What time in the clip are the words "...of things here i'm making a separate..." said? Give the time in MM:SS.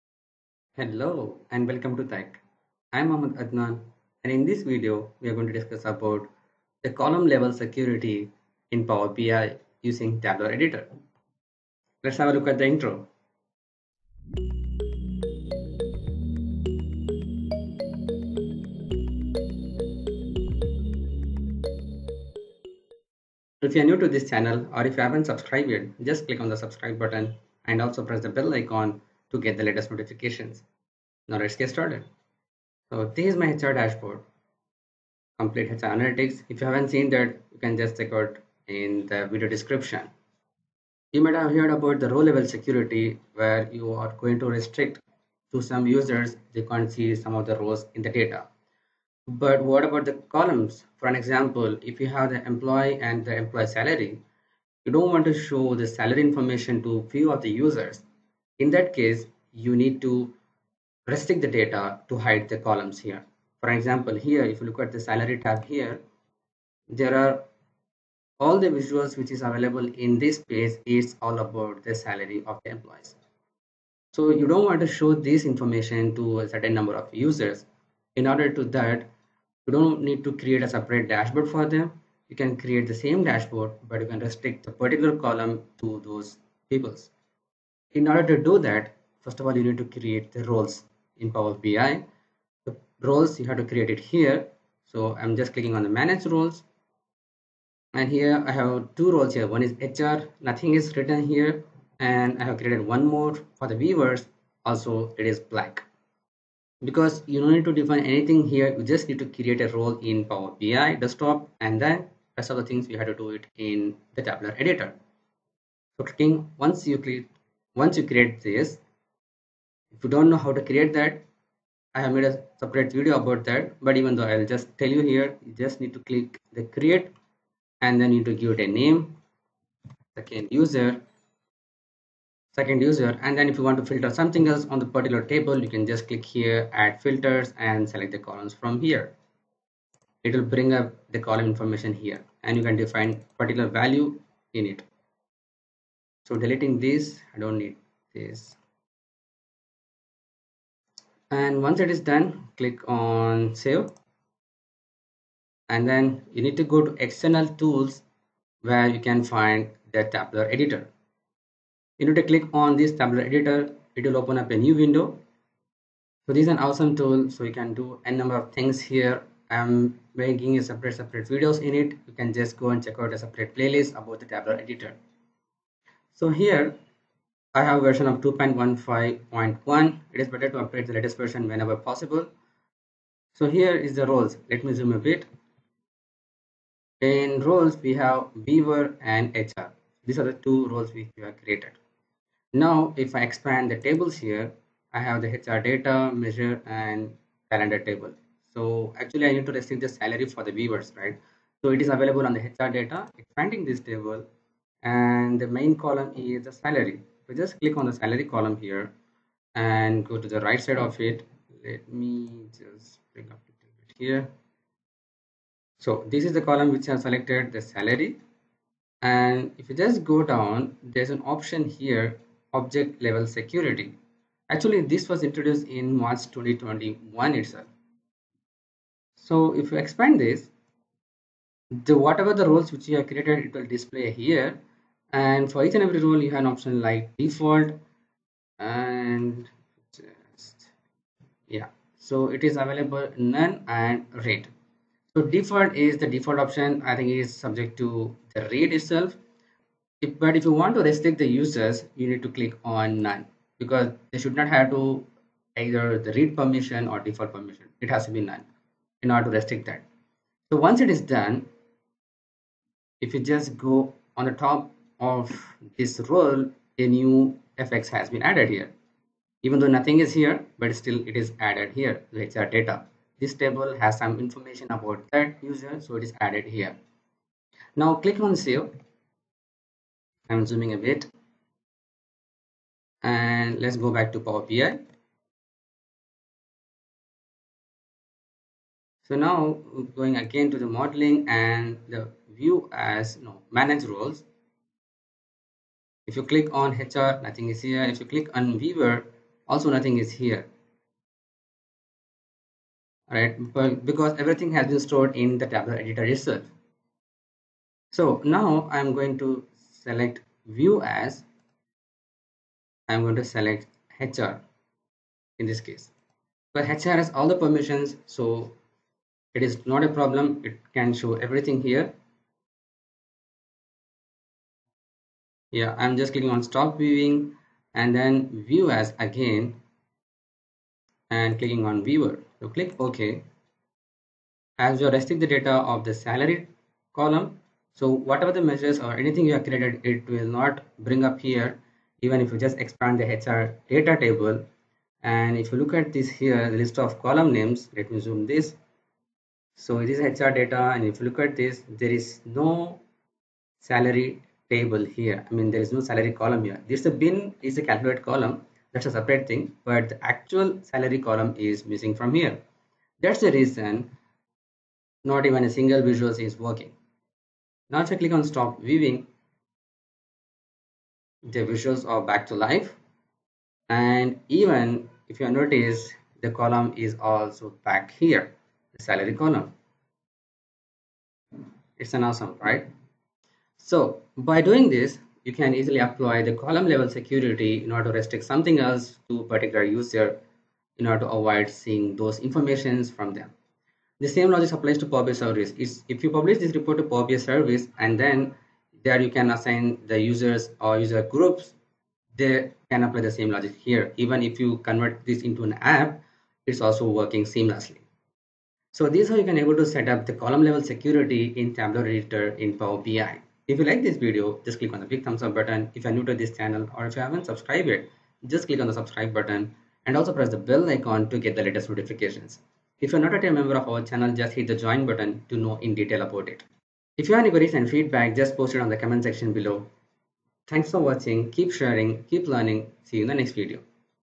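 02:48.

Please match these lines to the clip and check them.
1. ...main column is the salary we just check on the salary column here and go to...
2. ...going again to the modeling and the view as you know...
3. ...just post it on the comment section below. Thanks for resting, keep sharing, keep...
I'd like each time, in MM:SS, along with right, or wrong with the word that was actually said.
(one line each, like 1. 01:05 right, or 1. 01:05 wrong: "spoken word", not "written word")
1. 03:25 wrong: "click", not "check"
2. 04:50 right
3. 07:08 wrong: "watching", not "resting".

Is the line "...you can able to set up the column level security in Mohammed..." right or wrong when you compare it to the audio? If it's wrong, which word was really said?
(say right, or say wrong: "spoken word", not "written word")
wrong: "Tabular", not "Mohammed".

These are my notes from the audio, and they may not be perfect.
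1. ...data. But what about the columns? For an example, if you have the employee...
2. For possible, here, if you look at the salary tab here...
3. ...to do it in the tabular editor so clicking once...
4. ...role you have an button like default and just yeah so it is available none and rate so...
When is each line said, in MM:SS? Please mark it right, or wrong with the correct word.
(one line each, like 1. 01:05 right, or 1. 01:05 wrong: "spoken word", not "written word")
1. 00:48 right
2. 01:03 wrong: "example", not "possible"
3. 01:53 right
4. 03:55 wrong: "option", not "button".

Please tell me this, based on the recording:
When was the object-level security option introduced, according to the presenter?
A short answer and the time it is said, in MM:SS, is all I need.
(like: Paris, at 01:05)
March 2021, at 03:45.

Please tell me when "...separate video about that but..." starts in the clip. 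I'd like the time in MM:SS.
02:02.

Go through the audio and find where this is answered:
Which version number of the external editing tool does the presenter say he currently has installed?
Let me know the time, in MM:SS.
02:58.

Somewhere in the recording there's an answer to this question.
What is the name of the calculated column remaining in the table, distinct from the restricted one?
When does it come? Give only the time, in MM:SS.
05:56.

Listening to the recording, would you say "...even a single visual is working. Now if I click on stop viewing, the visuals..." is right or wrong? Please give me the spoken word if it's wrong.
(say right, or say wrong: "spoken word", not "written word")
right.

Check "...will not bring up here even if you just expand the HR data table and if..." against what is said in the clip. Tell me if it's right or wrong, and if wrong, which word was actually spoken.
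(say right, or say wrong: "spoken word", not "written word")
right.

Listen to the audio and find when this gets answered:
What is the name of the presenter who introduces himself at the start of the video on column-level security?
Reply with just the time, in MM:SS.
00:03.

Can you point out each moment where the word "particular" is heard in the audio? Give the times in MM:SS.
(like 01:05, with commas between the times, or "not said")
01:24, 02:14, 02:23, 06:29.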